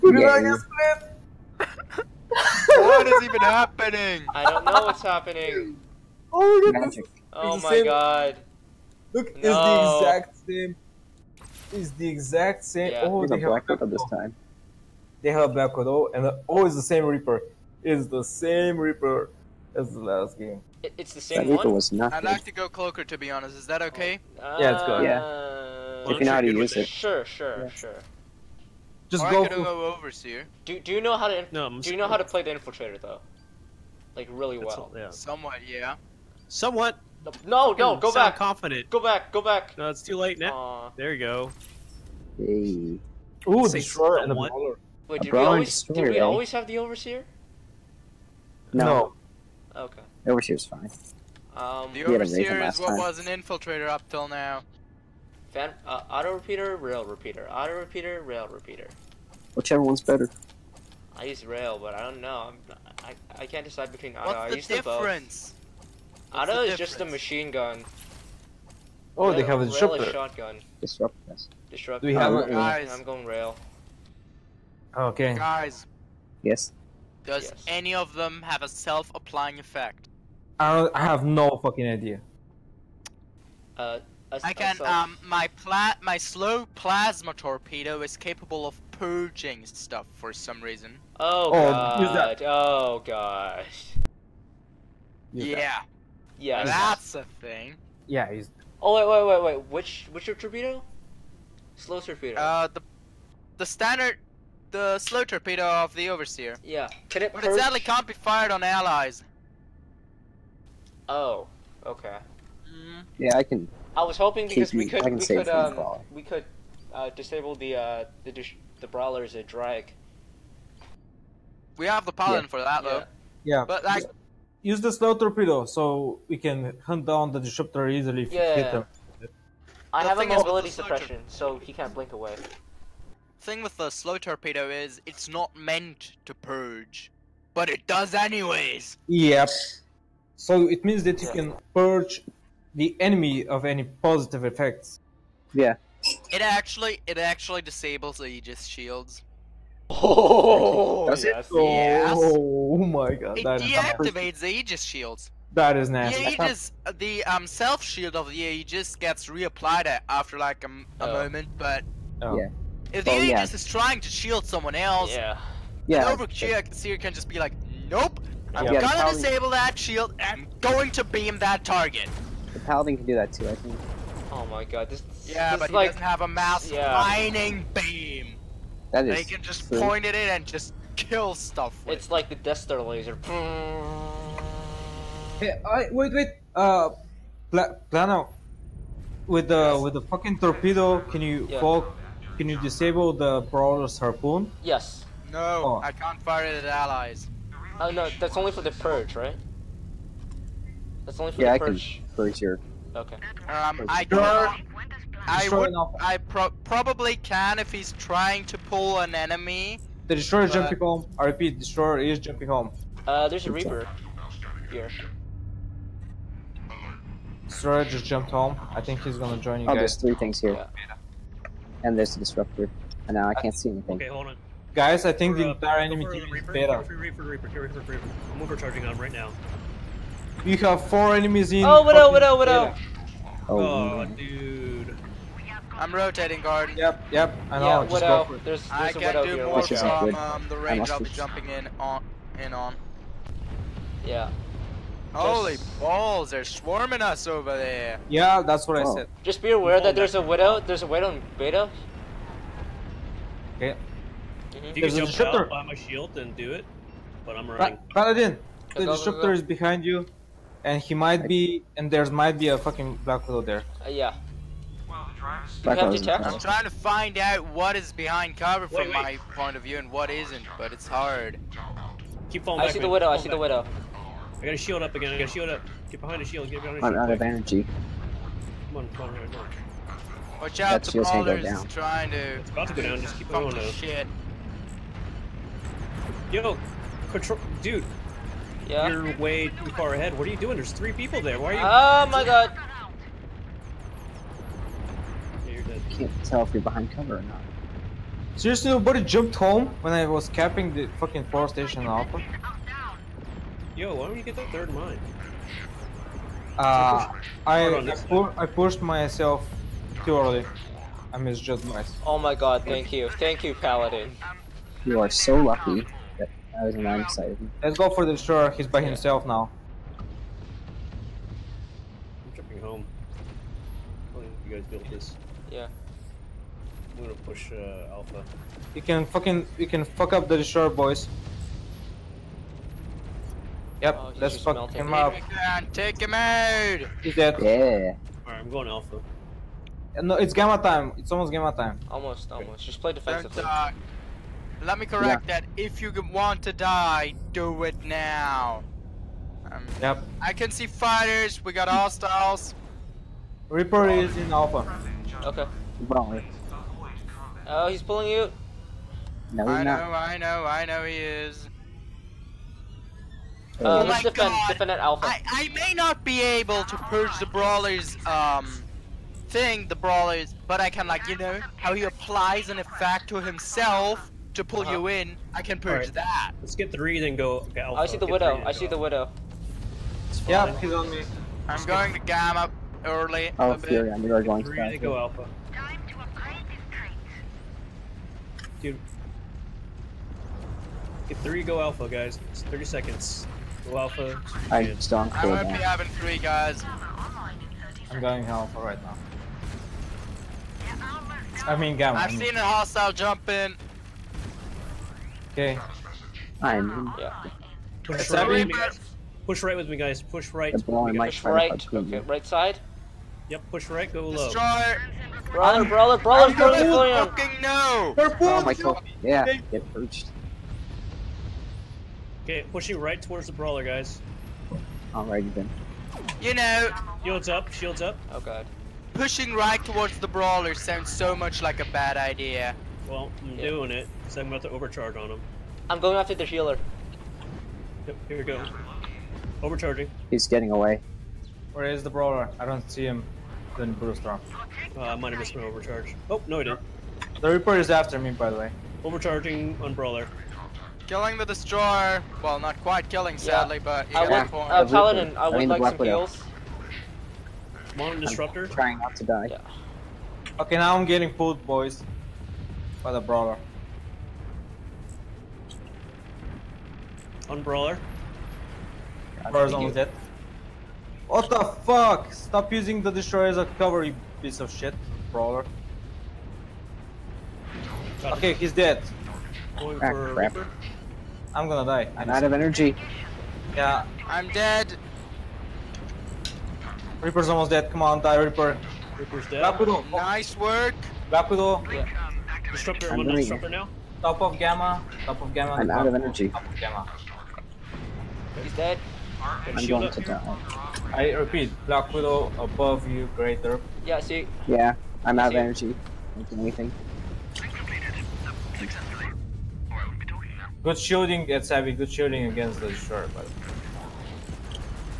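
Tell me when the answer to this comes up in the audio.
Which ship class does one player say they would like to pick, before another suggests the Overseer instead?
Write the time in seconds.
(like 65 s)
22 s.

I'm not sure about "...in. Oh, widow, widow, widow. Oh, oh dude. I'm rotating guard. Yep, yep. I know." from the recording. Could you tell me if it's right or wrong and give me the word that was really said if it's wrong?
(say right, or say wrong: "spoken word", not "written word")
right.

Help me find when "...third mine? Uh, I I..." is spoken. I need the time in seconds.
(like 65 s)
304 s.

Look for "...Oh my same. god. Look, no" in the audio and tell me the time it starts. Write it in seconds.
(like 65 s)
7 s.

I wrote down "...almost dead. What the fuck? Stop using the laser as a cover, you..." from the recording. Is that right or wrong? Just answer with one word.
wrong.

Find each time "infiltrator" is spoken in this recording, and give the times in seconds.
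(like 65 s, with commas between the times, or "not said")
32 s, 53 s.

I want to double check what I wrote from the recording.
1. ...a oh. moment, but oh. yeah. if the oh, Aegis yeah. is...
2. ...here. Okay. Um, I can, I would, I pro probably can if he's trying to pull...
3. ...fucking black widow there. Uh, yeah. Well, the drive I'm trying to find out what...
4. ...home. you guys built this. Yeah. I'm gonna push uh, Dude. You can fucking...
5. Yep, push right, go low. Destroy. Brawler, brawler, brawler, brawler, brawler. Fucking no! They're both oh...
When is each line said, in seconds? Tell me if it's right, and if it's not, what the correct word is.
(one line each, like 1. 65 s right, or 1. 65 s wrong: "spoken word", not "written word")
1. 161 s right
2. 202 s right
3. 262 s right
4. 322 s wrong: "Alpha", not "Dude"
5. 413 s right.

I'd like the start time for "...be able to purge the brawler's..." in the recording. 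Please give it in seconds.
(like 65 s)
366 s.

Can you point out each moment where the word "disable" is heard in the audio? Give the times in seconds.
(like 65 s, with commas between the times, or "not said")
117 s, 147 s, 169 s, 192 s.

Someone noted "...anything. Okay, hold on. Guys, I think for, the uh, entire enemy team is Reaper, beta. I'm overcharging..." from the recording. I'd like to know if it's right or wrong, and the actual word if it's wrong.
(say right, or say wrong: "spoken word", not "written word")
right.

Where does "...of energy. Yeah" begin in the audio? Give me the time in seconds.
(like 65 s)
482 s.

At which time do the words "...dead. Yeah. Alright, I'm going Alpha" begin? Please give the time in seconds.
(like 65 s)
337 s.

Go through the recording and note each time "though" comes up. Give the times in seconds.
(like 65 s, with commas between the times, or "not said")
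33 s, 122 s, 283 s.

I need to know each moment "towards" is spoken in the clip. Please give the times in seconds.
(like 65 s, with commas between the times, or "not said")
422 s, 429 s.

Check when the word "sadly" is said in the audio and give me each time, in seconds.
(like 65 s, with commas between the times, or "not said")
107 s, 453 s.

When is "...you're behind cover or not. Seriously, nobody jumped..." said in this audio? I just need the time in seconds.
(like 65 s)
296 s.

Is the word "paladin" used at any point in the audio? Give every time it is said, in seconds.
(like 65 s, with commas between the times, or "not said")
122 s, 172 s, 258 s, 313 s, 454 s.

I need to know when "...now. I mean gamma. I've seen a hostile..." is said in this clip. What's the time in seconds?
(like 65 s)
398 s.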